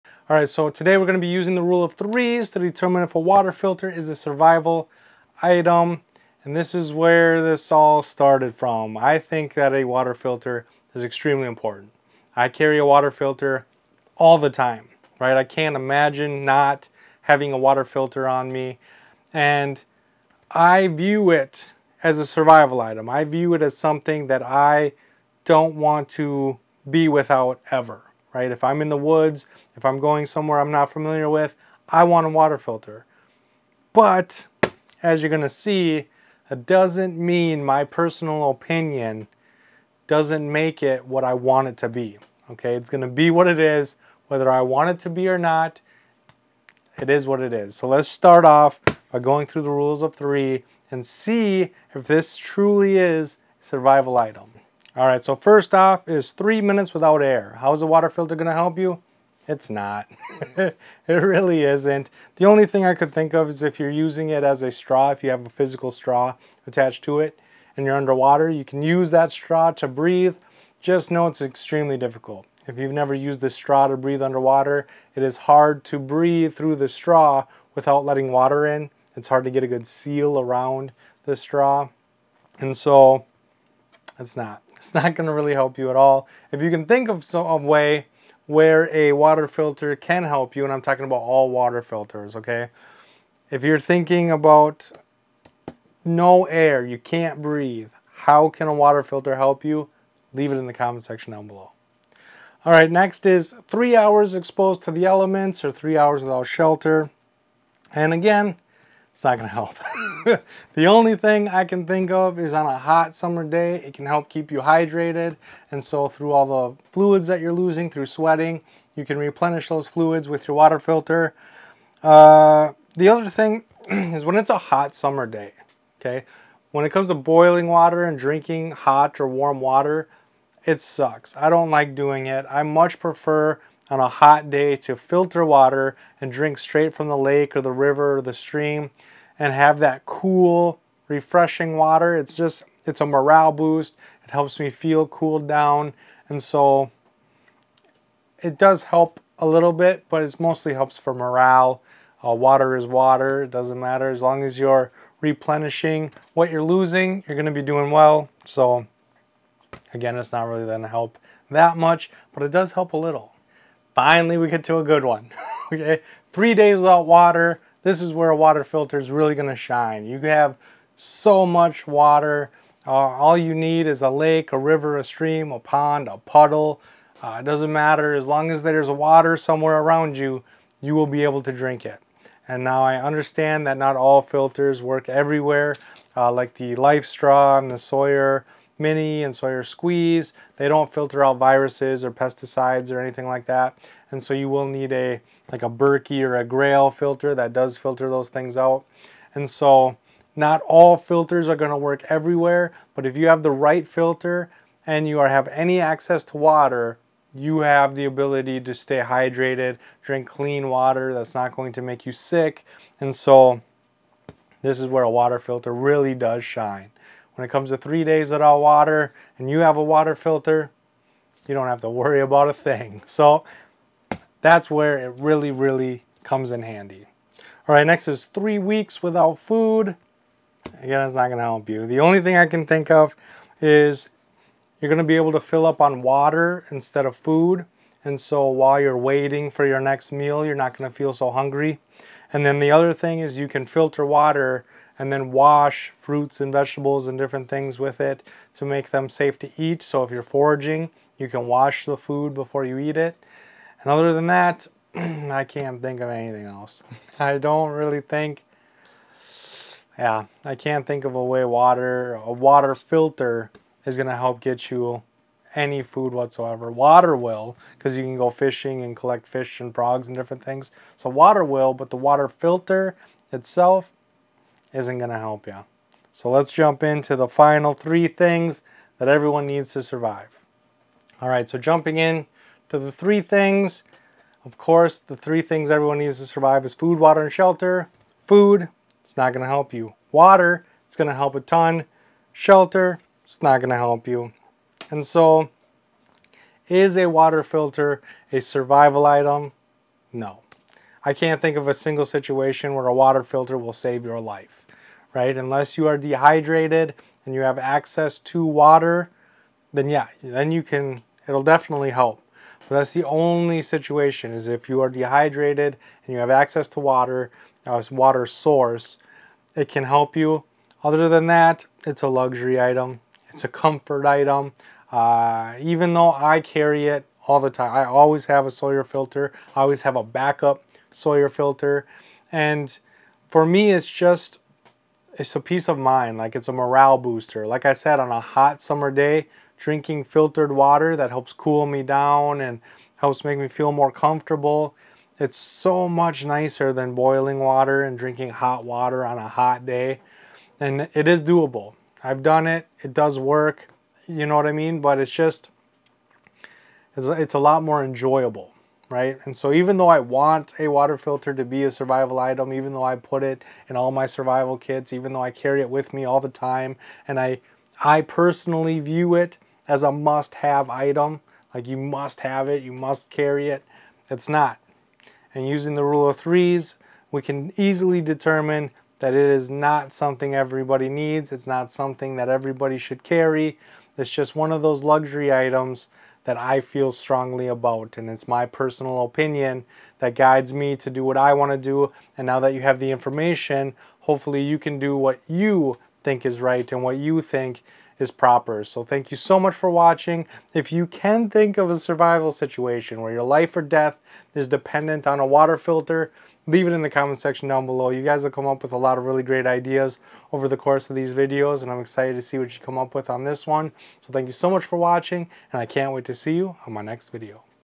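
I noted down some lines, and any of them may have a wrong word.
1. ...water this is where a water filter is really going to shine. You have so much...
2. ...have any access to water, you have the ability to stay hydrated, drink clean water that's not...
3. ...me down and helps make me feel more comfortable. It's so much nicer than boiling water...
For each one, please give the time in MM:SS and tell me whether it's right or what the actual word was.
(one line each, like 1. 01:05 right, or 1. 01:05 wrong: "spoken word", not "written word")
1. 02:47 right
2. 03:25 right
3. 05:41 right.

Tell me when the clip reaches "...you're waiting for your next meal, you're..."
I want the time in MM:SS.
03:58.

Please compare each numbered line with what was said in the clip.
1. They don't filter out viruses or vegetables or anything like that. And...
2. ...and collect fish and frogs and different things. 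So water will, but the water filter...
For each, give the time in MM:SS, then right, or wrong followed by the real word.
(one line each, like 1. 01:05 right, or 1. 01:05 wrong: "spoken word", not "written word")
1. 03:10 wrong: "pesticides", not "vegetables"
2. 04:28 right.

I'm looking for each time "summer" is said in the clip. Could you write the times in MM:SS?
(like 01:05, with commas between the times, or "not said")
01:53, 02:04, 05:38.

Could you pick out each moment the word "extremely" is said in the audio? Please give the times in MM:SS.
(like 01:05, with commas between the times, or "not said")
00:11, 01:11.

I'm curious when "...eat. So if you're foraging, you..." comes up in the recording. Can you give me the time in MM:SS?
04:09.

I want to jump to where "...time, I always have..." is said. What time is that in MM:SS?
05:27.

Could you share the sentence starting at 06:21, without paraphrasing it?
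It's not something that everybody should carry.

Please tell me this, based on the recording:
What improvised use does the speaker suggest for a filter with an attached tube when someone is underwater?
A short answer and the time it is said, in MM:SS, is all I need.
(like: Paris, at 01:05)
Breathe through the straw, at 01:08.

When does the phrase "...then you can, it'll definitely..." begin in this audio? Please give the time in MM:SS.
05:10.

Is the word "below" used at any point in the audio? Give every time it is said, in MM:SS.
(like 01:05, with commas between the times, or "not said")
01:41, 06:47.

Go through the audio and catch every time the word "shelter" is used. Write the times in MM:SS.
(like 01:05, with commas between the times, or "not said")
01:46, 04:47, 04:52.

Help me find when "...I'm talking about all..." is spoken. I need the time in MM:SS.
01:30.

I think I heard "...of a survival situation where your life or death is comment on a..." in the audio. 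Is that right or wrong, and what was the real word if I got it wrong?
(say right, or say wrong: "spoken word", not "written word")
wrong: "dependent", not "comment".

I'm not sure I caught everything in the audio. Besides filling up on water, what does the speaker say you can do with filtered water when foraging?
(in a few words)
Wash fruits and vegetables.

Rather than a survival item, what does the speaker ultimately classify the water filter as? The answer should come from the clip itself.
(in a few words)
A luxury item.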